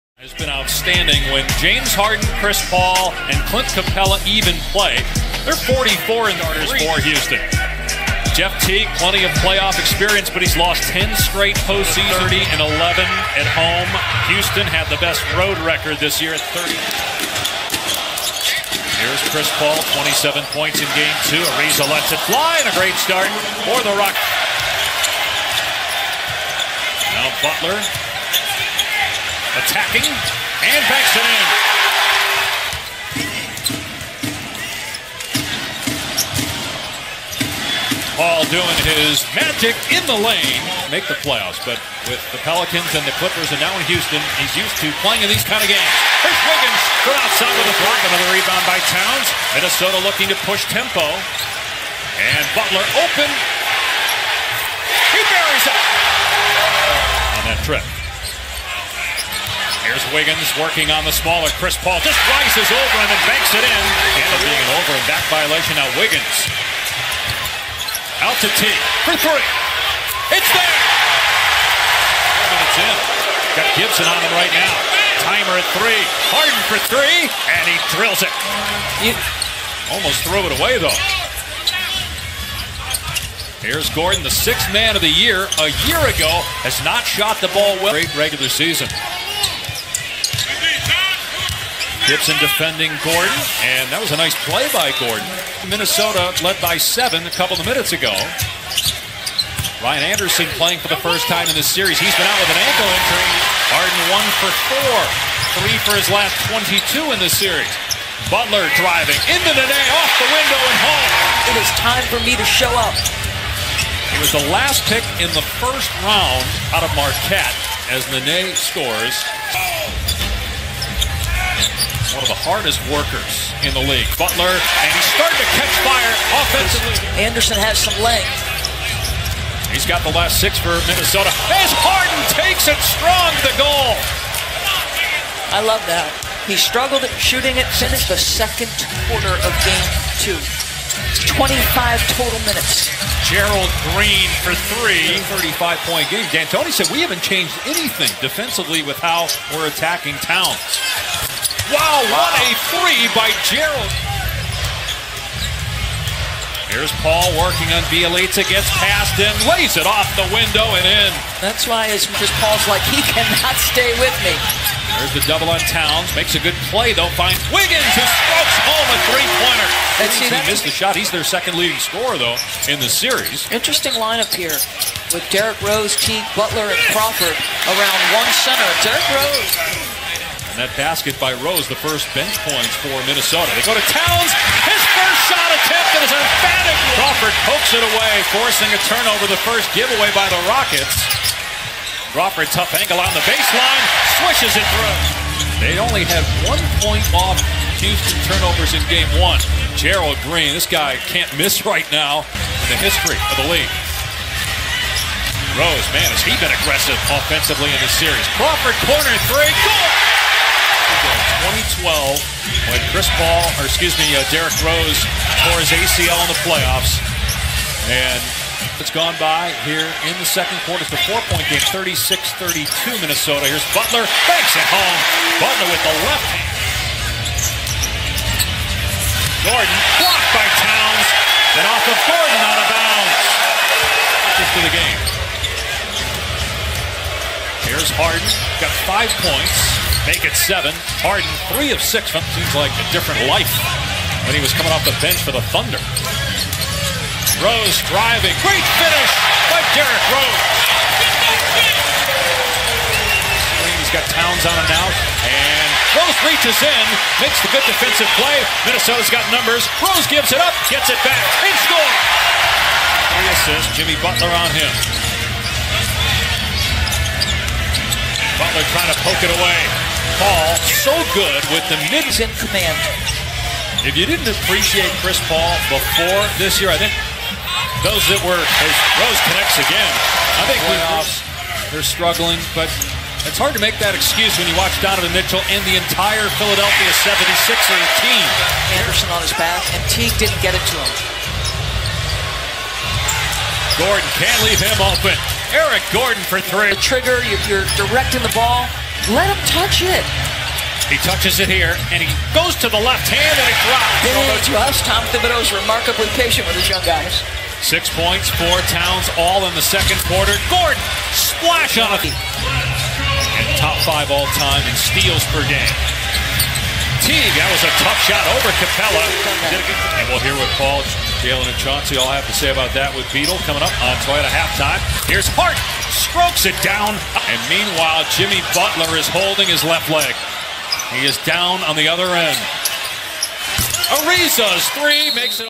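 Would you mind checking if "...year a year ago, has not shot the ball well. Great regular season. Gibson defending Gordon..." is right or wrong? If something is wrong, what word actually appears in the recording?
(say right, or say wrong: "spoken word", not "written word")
right.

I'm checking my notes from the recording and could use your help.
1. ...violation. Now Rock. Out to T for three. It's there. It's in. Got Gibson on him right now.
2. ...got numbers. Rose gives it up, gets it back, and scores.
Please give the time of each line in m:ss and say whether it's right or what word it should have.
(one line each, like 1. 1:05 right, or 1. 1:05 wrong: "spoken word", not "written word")
1. 1:05 wrong: "Wiggins", not "Rock"
2. 4:19 right.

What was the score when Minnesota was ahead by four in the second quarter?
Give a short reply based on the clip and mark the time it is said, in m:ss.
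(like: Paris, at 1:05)
36-32, at 3:41.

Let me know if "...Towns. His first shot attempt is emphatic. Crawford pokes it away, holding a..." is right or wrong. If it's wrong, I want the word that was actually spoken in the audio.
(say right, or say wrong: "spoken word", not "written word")
wrong: "forcing", not "holding".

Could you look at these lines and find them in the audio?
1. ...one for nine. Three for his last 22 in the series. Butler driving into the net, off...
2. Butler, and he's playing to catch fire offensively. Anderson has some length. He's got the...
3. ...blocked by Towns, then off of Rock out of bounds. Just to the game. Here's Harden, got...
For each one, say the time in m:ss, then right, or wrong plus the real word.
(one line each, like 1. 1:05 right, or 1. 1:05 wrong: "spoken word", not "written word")
1. 1:44 wrong: "four", not "nine"
2. 2:04 wrong: "starting", not "playing"
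3. 3:49 wrong: "Gordon", not "Rock".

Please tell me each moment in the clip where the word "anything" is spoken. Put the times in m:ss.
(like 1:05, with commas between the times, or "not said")
2:27.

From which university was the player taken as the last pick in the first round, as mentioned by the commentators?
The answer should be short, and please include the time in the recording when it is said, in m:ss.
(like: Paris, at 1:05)
Marquette, at 1:56.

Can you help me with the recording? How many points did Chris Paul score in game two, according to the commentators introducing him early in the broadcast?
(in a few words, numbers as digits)
27.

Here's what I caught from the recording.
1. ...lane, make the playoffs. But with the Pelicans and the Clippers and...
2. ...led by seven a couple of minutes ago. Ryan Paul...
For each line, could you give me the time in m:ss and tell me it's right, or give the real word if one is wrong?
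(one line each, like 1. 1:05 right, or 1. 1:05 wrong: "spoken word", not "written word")
1. 0:40 right
2. 1:36 wrong: "Anderson", not "Paul".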